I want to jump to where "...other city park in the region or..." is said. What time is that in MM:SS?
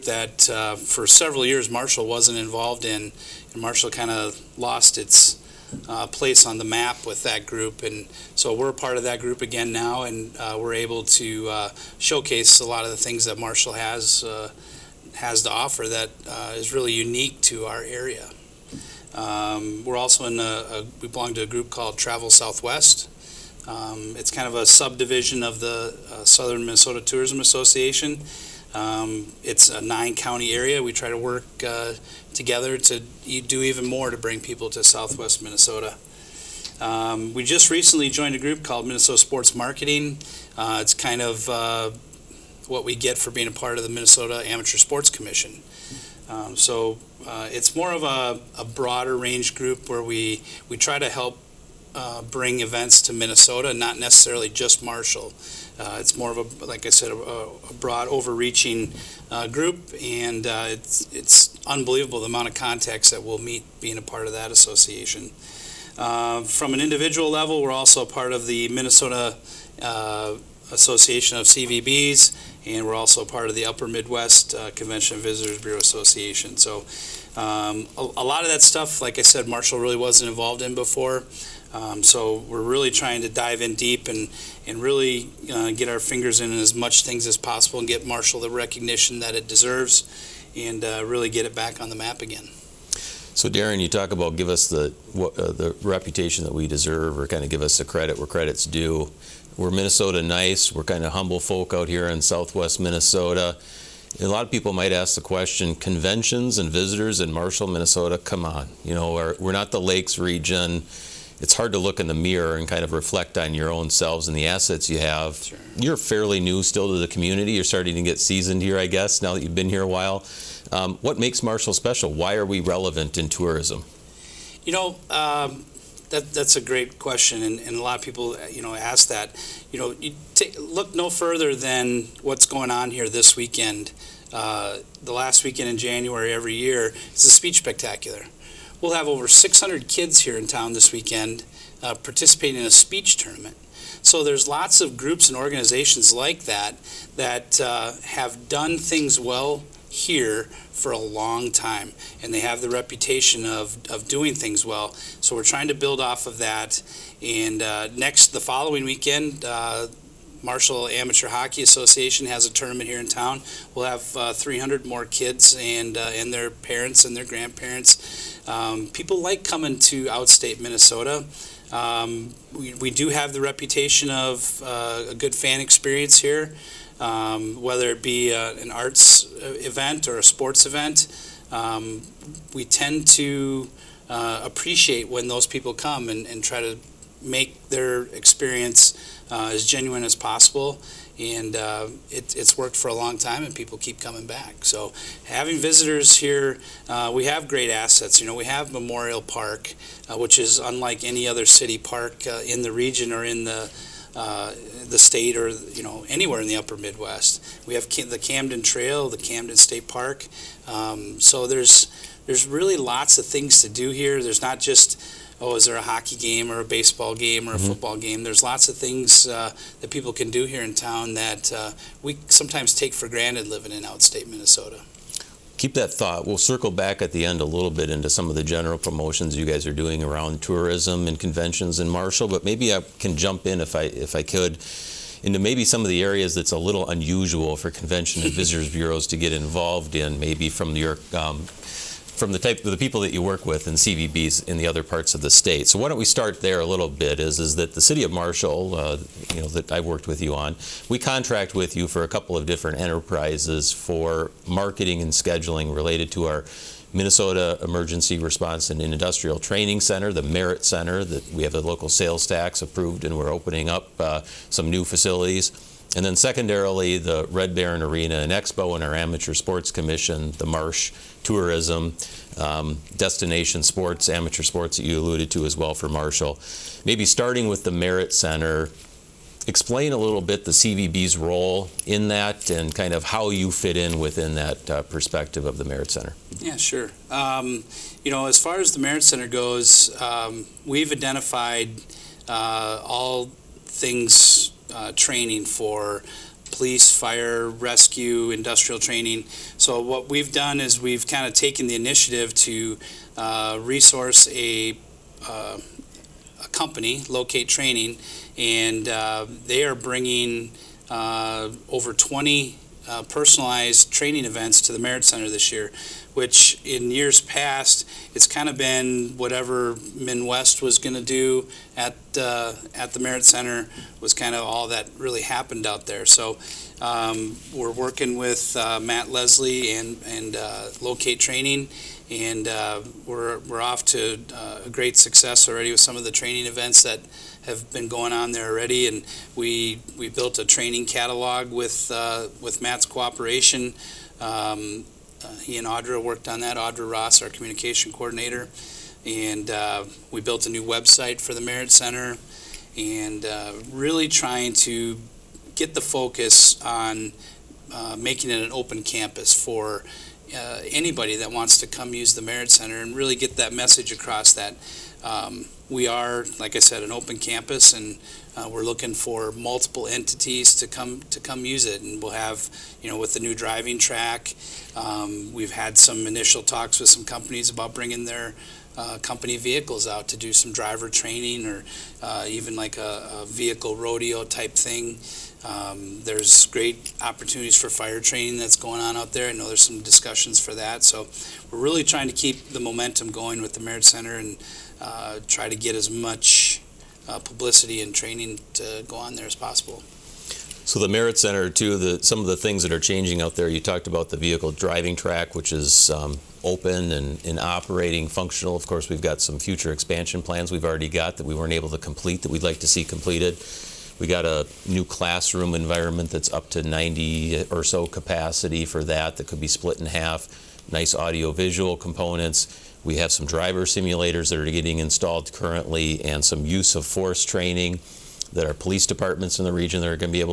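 03:21.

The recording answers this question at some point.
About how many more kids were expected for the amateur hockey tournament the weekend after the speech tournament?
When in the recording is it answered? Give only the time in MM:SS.
02:44.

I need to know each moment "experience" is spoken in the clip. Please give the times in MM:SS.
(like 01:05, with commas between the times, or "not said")
02:55, 03:08.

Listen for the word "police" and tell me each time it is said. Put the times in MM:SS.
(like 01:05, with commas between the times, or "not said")
04:56, 07:08.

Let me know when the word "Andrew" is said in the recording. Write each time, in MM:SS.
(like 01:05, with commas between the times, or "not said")
not said.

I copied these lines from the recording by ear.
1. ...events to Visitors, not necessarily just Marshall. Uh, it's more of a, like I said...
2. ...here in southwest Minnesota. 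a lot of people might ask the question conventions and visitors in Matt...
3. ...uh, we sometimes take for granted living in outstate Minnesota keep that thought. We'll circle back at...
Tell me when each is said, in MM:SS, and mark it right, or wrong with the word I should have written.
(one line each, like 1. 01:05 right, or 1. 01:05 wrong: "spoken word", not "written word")
1. 00:52 wrong: "Minnesota", not "Visitors"
2. 01:41 wrong: "Marshall", not "Matt"
3. 03:41 right.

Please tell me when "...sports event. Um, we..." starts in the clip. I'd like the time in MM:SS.
03:00.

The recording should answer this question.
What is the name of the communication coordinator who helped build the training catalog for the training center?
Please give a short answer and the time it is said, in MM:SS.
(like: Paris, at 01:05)
Audra Ross, at 05:46.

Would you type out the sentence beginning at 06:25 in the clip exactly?
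Um, there's great opportunities for fire training that's going on out there.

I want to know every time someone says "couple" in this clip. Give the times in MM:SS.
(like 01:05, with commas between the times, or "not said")
04:12.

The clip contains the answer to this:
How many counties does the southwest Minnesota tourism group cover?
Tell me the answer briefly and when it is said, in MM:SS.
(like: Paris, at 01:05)
9, at 00:29.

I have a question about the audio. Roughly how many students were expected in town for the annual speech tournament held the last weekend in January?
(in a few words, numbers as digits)
600.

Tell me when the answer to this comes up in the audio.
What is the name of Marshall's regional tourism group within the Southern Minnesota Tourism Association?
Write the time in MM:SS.
00:21.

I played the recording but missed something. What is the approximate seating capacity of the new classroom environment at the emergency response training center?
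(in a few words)
90.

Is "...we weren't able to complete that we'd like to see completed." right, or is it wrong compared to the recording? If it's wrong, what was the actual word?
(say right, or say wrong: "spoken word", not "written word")
right.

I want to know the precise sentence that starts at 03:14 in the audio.
So having visitors here, uh, we have great assets.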